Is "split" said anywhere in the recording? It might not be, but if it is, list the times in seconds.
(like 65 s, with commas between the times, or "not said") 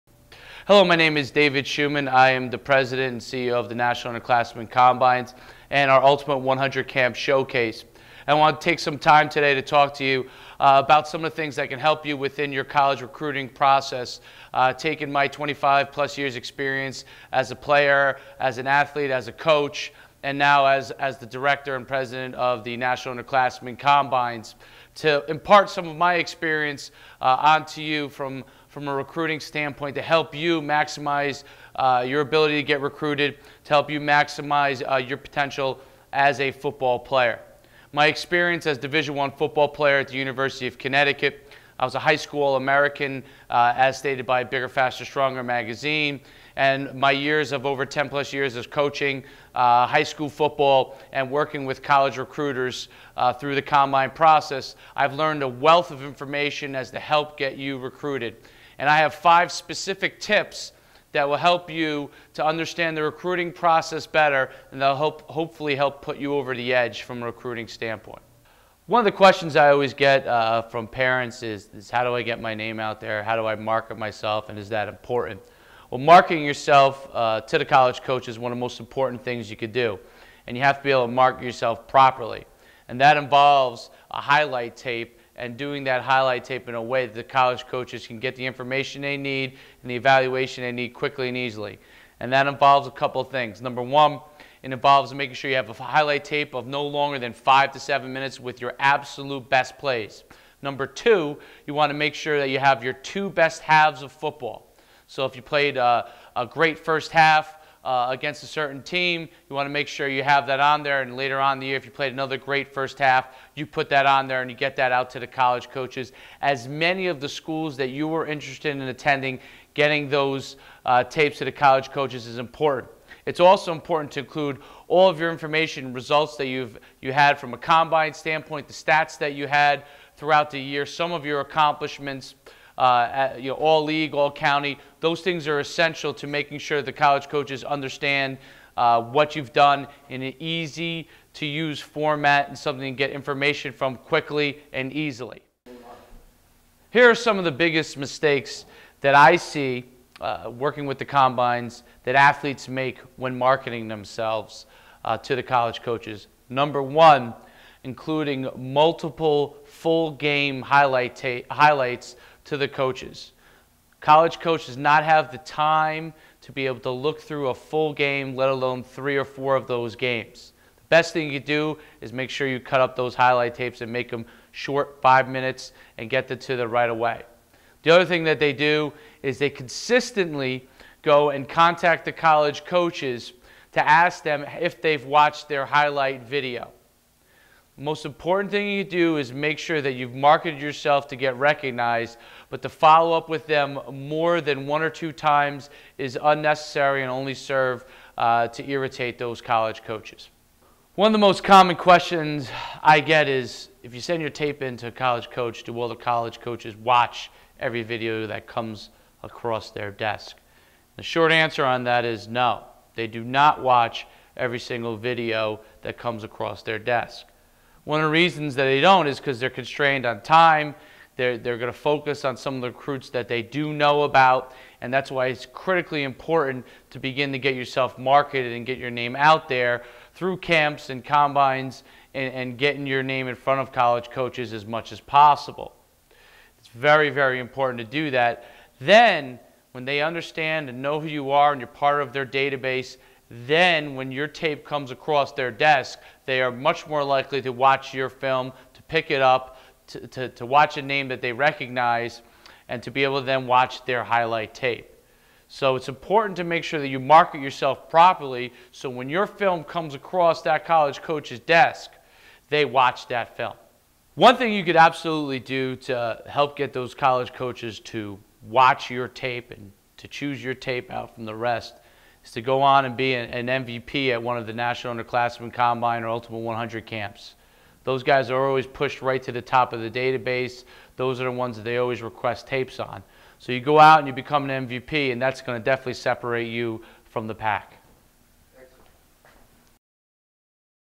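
not said.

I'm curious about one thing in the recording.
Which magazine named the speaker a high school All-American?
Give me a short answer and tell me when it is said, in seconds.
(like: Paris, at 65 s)
Bigger, Faster, Stronger, at 44 s.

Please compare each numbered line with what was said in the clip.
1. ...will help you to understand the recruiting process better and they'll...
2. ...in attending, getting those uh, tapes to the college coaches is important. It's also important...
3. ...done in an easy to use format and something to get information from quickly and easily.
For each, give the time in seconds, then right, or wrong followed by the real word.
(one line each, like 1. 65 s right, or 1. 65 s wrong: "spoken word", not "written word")
1. 61 s right
2. 118 s right
3. 139 s right.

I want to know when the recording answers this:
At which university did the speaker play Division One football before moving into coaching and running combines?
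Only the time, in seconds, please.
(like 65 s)
40 s.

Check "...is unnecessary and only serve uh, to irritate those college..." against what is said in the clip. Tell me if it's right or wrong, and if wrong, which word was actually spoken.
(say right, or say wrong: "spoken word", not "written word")
right.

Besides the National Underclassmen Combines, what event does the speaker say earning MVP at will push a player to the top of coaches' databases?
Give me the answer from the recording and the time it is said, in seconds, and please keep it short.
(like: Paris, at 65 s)
Ultimate 100 camps, at 276 s.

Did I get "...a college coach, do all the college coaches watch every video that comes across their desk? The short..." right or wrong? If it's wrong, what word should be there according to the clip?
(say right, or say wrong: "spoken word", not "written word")
right.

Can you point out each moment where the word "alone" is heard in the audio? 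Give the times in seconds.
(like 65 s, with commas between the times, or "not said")
168 s.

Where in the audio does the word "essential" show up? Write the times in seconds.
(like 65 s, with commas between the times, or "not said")
135 s.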